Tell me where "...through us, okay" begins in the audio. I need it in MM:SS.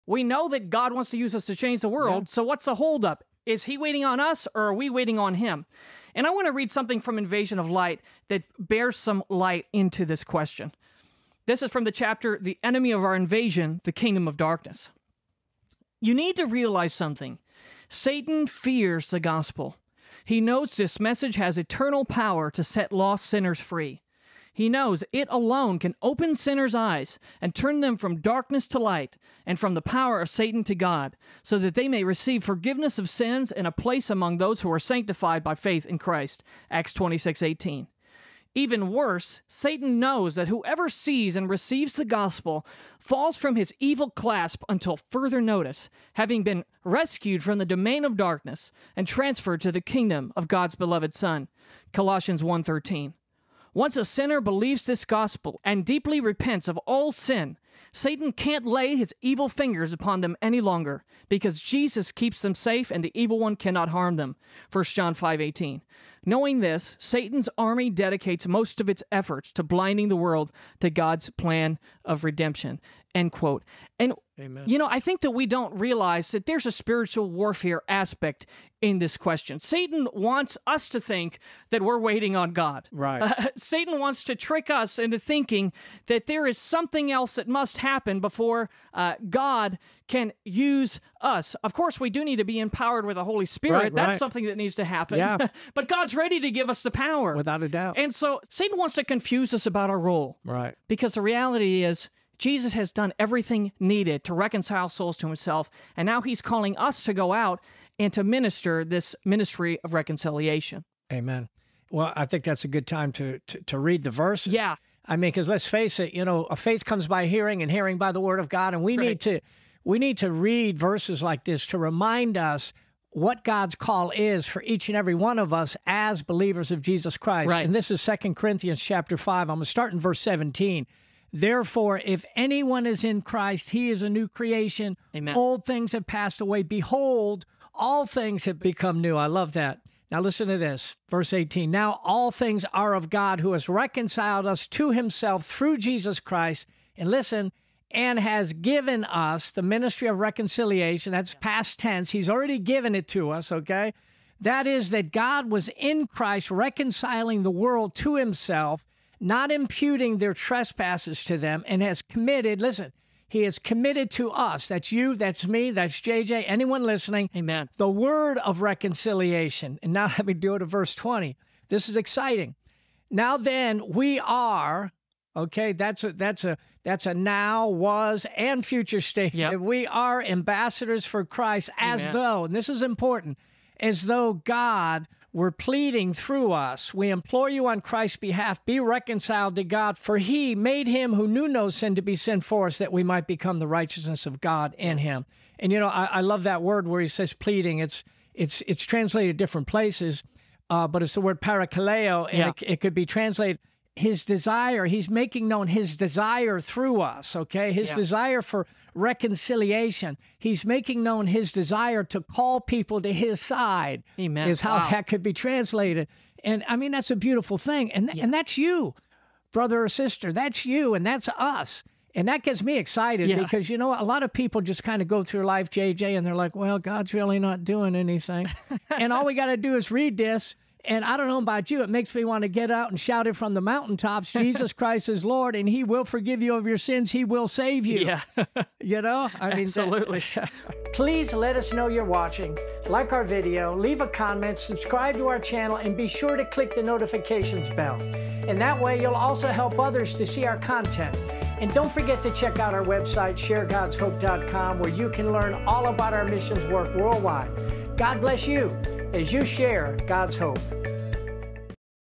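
03:26.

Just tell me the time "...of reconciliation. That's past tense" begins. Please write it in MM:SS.
02:30.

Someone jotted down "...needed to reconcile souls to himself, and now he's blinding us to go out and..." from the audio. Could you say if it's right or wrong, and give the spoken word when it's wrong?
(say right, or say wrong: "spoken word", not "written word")
wrong: "calling", not "blinding".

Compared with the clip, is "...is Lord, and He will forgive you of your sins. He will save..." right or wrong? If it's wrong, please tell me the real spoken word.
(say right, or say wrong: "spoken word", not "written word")
right.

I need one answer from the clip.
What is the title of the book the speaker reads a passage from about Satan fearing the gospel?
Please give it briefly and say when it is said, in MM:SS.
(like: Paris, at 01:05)
Invasion of Light, at 00:07.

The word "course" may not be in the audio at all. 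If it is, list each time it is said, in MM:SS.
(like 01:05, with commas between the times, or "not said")
01:31.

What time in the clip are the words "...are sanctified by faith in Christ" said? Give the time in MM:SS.
00:34.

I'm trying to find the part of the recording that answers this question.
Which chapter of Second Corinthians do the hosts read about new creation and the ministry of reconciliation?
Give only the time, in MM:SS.
02:08.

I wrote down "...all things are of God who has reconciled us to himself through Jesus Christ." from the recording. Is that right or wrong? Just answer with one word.
right.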